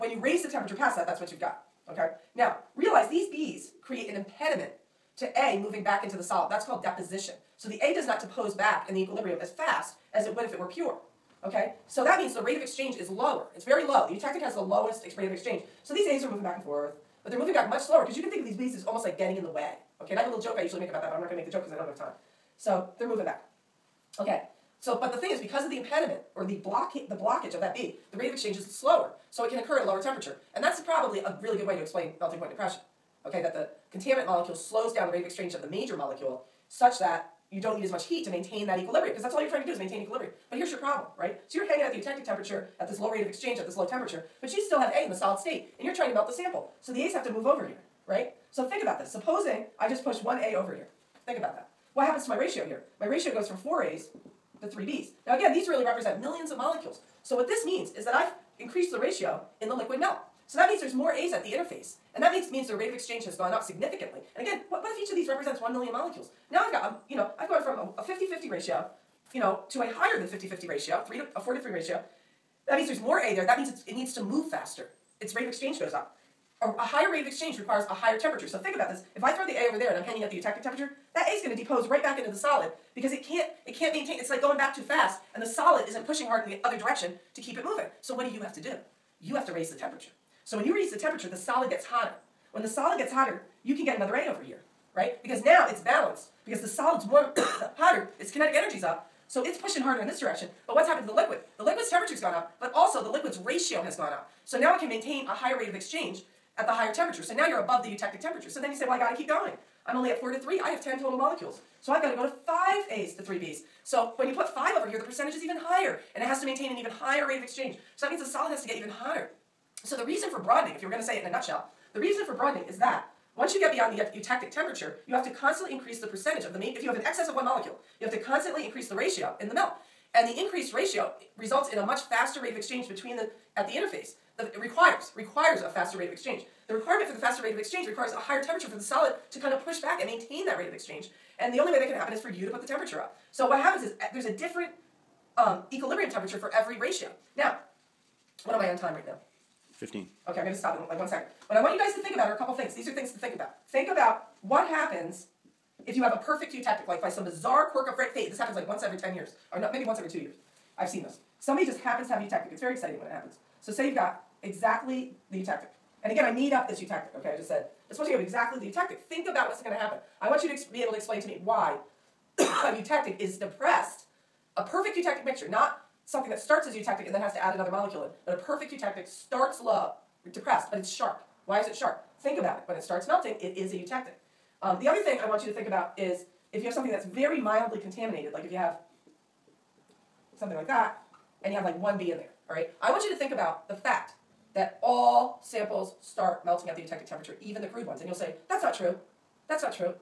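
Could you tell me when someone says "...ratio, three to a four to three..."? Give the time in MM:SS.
01:10.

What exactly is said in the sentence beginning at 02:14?
The, it requires, requires a faster rate of exchange.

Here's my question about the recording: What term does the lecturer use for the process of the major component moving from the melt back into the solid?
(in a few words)
Deposition.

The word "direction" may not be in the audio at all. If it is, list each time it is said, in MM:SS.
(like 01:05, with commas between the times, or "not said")
01:26, 01:40.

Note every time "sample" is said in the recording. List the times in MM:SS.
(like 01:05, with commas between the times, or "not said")
00:46, 03:15.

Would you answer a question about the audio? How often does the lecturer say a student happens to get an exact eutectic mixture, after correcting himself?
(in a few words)
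Once every two years.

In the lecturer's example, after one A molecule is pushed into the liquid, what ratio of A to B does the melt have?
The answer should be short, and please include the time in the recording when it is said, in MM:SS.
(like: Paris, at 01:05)
4 to 3, at 00:53.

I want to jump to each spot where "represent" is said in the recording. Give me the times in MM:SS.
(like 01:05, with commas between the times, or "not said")
00:55, 01:05.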